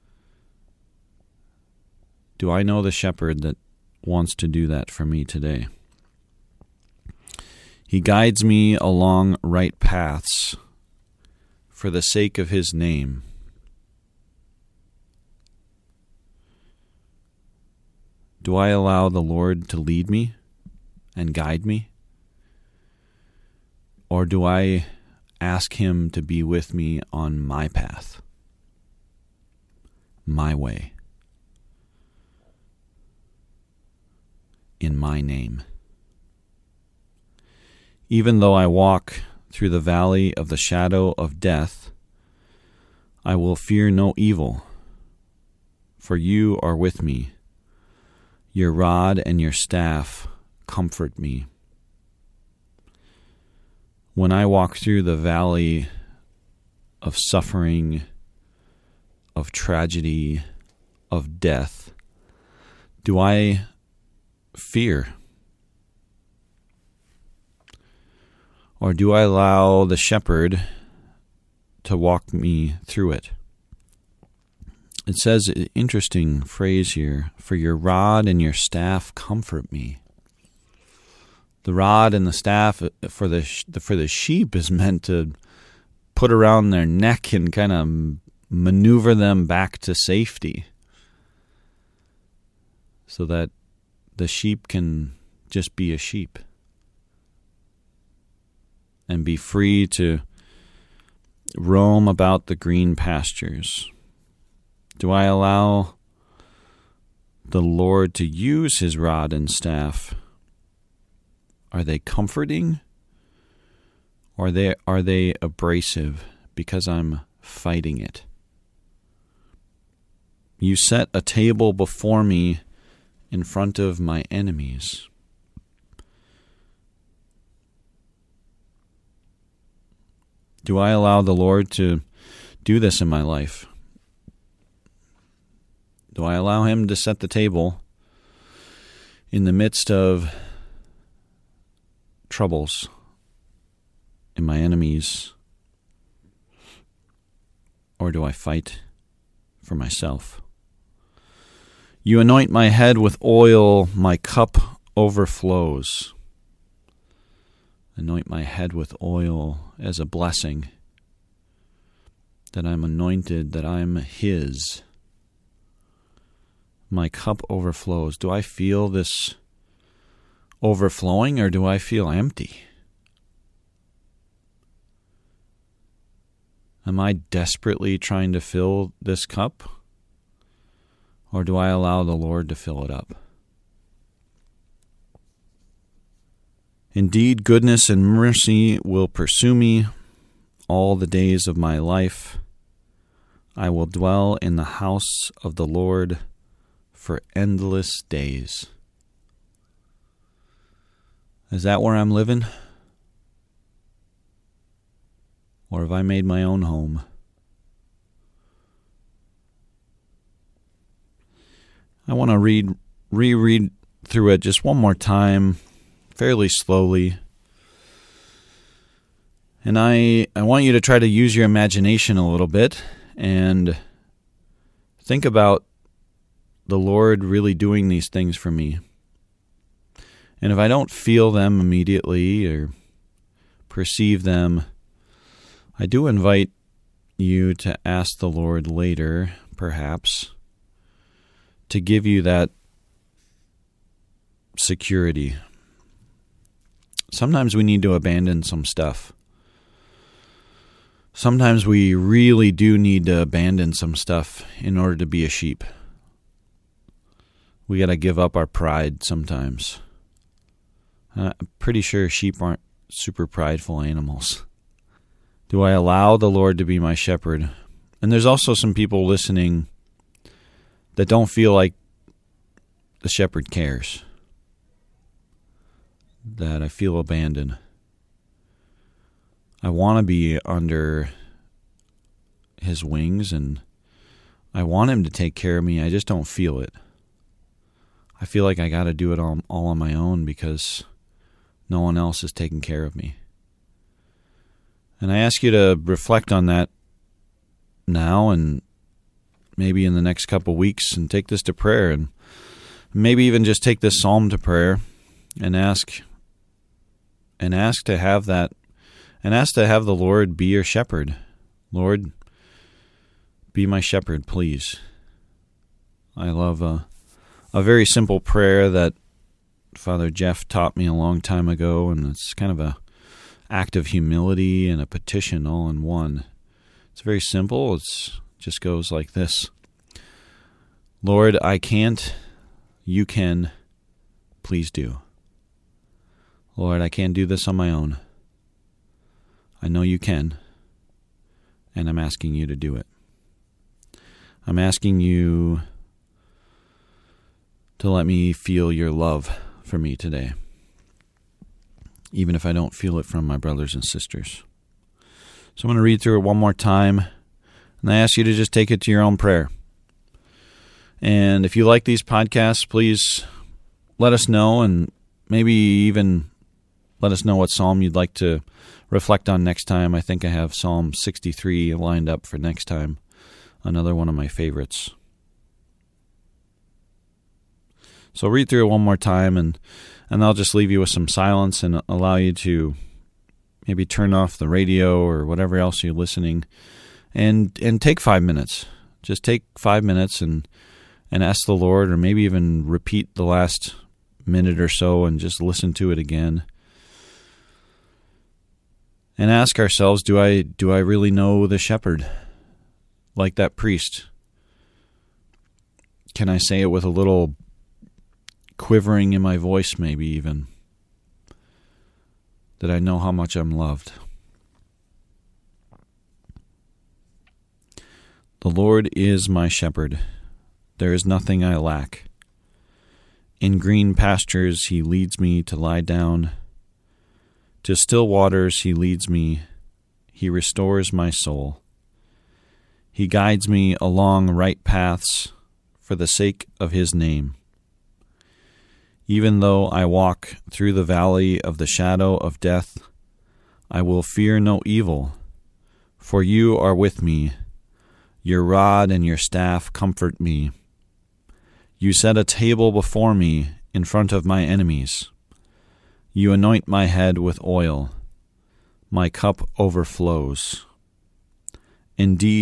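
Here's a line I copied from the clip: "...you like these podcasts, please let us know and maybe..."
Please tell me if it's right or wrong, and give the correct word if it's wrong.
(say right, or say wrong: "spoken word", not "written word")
right.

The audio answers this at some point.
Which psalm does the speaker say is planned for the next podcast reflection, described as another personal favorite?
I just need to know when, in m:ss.
6:10.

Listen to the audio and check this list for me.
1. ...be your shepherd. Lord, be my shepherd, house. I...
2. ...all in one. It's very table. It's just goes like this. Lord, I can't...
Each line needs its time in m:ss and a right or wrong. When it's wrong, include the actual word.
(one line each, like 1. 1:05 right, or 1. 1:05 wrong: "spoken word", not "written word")
1. 5:10 wrong: "please", not "house"
2. 5:25 wrong: "simple", not "table".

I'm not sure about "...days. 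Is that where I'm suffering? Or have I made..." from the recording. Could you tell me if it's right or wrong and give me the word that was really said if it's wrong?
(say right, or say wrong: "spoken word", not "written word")
wrong: "living", not "suffering".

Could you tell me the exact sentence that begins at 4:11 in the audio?
Sometimes we really do need to abandon some stuff in order to be a sheep.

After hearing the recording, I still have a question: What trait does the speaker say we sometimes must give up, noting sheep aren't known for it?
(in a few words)
Pride.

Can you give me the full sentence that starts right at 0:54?
When I walk through the valley of suffering, of tragedy, of death, do I fear?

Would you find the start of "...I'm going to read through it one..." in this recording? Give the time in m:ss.
5:55.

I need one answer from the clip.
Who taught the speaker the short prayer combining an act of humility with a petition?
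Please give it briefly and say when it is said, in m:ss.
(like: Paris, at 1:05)
Father Jeff, at 5:19.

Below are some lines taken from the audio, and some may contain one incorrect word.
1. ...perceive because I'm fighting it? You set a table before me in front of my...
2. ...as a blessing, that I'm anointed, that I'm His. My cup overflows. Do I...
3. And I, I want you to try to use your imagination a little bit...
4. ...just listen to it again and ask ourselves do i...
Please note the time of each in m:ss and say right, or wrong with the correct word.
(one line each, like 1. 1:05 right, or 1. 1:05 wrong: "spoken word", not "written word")
1. 1:55 wrong: "abrasive", not "perceive"
2. 2:39 right
3. 3:39 right
4. 6:35 right.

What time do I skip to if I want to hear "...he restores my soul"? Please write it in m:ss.
7:10.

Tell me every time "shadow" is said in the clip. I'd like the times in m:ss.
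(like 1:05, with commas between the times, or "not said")
0:40, 7:21.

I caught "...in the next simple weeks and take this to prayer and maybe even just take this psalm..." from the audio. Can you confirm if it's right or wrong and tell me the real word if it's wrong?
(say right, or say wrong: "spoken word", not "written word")
wrong: "couple", not "simple".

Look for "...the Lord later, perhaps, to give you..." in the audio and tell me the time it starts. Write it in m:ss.
3:58.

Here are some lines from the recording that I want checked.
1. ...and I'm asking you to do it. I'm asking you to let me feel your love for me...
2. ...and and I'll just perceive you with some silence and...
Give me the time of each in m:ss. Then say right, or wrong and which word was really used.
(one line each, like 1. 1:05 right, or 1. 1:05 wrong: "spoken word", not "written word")
1. 5:41 right
2. 6:19 wrong: "leave", not "perceive".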